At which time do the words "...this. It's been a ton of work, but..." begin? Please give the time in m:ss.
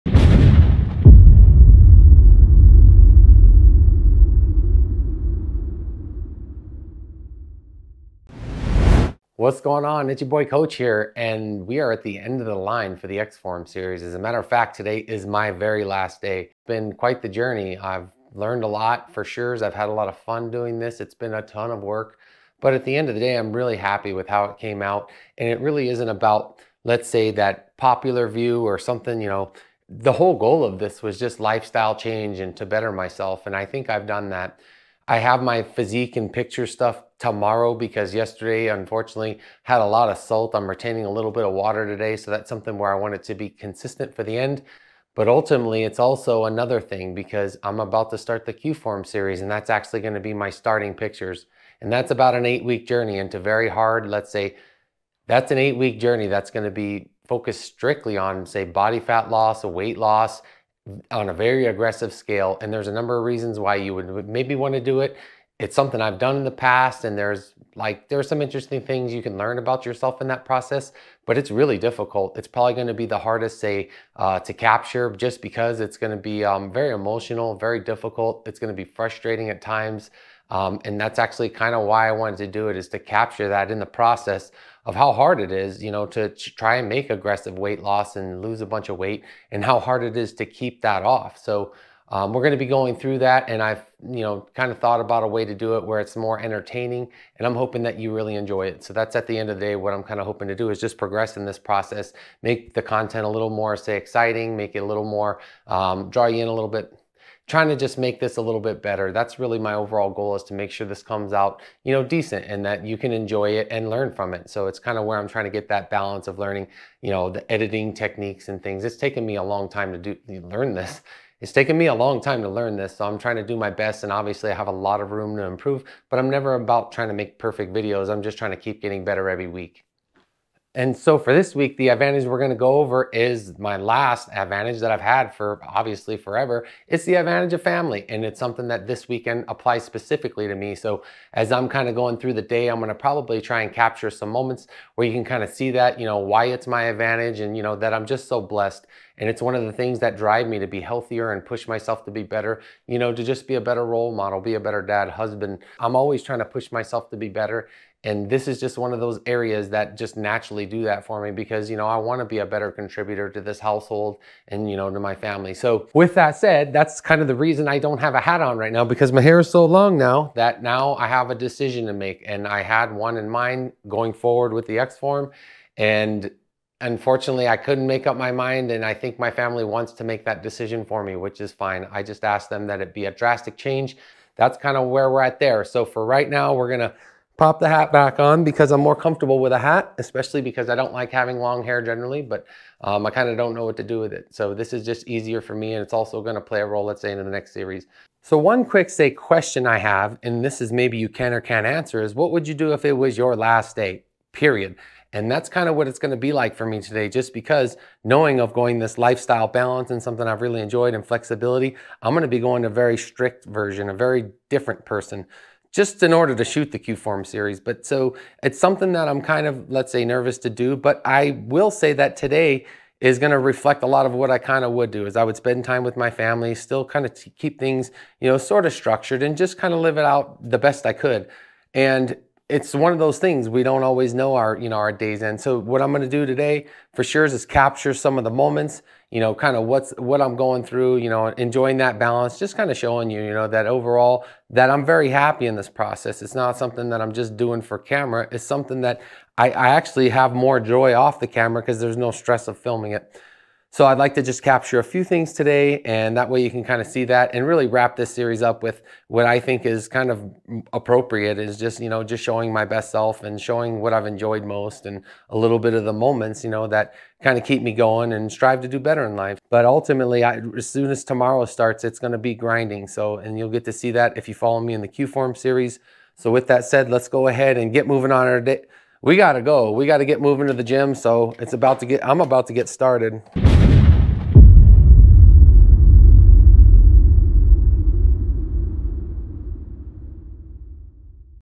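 0:20.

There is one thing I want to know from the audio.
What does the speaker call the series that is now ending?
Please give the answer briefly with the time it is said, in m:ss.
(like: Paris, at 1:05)
X Form series, at 0:13.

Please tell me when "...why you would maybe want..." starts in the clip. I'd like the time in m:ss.
1:03.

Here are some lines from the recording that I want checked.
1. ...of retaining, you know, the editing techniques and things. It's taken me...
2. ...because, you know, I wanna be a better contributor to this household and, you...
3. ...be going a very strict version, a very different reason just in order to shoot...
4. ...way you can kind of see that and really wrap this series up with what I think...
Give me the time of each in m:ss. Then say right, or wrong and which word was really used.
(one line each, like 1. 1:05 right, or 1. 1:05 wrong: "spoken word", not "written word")
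1. 1:56 wrong: "learning", not "retaining"
2. 2:41 right
3. 3:32 wrong: "person", not "reason"
4. 4:16 right.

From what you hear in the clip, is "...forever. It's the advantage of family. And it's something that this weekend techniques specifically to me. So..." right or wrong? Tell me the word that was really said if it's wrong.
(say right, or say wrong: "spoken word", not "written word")
wrong: "applies", not "techniques".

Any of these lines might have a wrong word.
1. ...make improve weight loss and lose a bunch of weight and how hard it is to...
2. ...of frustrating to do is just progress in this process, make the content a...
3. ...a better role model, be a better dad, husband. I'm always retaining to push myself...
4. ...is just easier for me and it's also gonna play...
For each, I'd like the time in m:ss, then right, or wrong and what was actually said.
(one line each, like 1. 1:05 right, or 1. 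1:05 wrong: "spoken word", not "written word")
1. 1:26 wrong: "aggressive", not "improve"
2. 1:40 wrong: "hoping", not "frustrating"
3. 2:33 wrong: "trying", not "retaining"
4. 3:14 right.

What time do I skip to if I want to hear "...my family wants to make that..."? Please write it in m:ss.
2:59.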